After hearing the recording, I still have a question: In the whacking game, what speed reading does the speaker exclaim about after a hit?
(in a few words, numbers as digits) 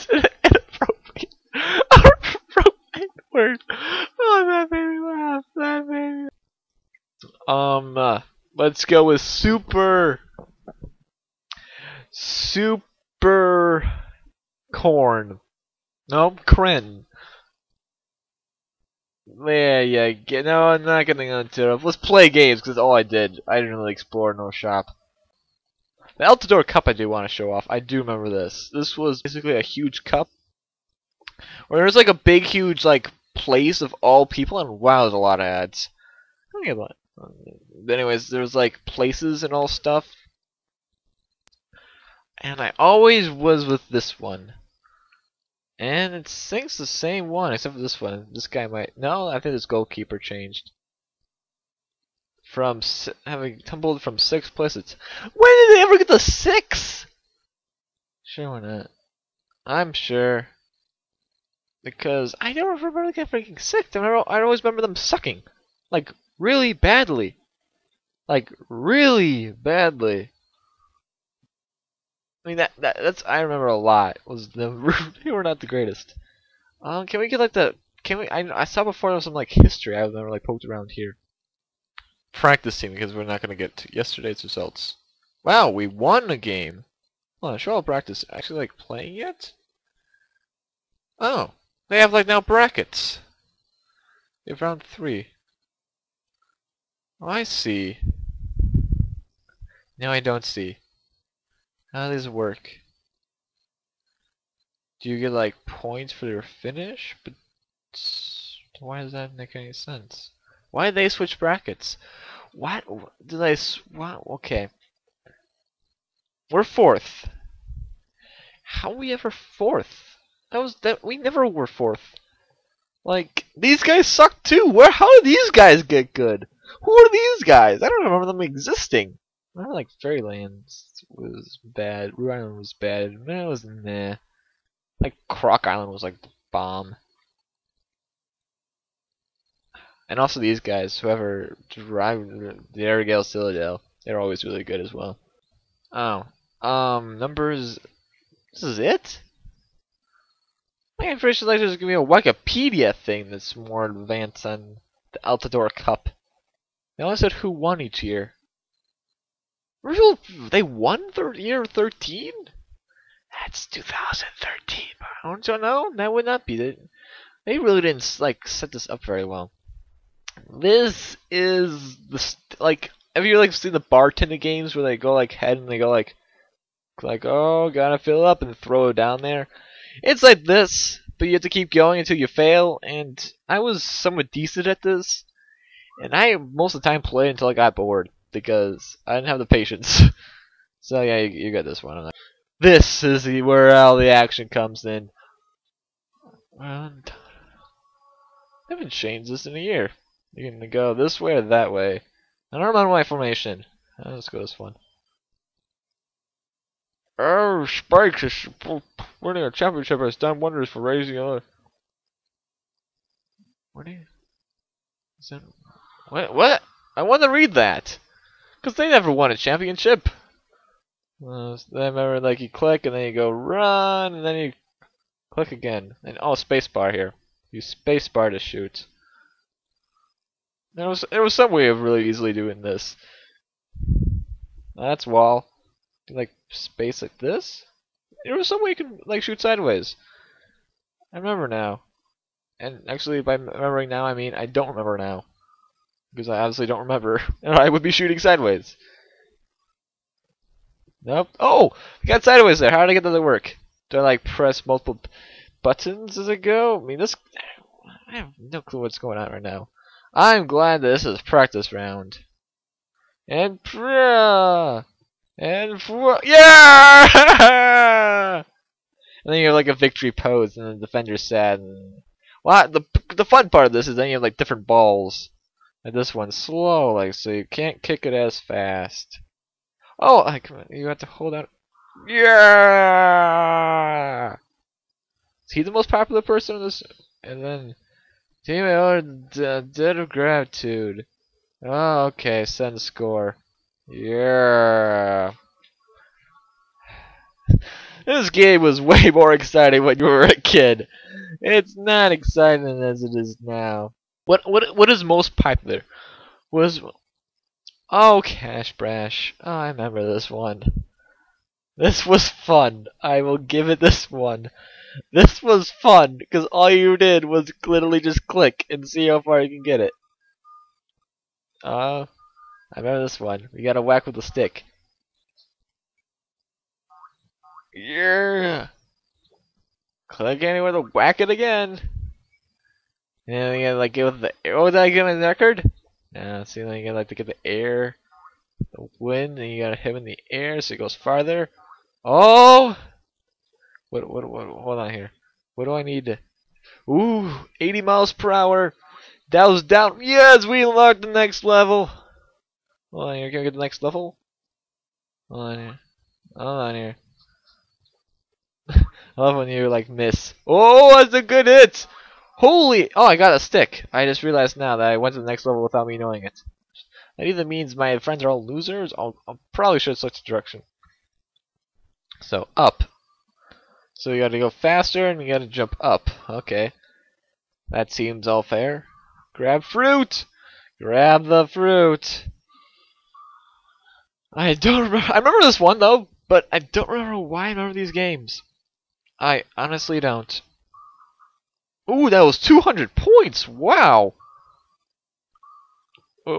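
80 miles per hour.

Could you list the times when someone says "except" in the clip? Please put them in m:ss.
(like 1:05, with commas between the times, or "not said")
0:47.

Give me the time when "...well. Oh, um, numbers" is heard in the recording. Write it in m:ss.
2:24.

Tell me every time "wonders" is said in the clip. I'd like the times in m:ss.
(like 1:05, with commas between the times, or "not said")
3:30.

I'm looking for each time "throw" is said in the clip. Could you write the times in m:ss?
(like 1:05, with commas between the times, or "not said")
2:58.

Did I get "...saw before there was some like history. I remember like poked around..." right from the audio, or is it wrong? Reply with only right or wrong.
right.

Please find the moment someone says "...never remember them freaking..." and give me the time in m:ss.
1:02.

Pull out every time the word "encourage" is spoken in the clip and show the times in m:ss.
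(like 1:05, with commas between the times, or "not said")
not said.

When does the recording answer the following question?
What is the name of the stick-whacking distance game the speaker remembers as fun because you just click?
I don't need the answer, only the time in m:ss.
5:08.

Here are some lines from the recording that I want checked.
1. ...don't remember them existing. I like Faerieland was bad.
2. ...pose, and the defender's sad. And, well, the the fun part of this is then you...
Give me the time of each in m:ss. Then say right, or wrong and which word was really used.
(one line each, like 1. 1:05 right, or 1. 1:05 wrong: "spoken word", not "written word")
1. 2:07 right
2. 4:30 right.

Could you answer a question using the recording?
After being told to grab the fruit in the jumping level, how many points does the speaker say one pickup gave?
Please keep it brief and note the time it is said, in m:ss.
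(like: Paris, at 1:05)
200, at 6:32.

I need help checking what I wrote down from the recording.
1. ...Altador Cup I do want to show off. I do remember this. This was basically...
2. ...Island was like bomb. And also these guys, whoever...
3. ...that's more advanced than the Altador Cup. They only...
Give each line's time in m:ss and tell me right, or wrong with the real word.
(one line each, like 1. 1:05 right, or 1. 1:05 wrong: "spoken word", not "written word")
1. 0:26 right
2. 2:15 right
3. 2:33 right.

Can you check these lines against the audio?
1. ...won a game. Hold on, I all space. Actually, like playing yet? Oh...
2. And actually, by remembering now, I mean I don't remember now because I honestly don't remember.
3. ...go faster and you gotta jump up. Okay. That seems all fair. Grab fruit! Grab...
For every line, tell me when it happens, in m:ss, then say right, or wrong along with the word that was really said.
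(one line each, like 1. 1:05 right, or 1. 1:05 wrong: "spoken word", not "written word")
1. 1:25 wrong: "practice", not "space"
2. 4:02 right
3. 6:14 right.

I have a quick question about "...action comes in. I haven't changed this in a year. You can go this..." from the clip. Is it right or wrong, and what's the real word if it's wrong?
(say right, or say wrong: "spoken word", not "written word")
right.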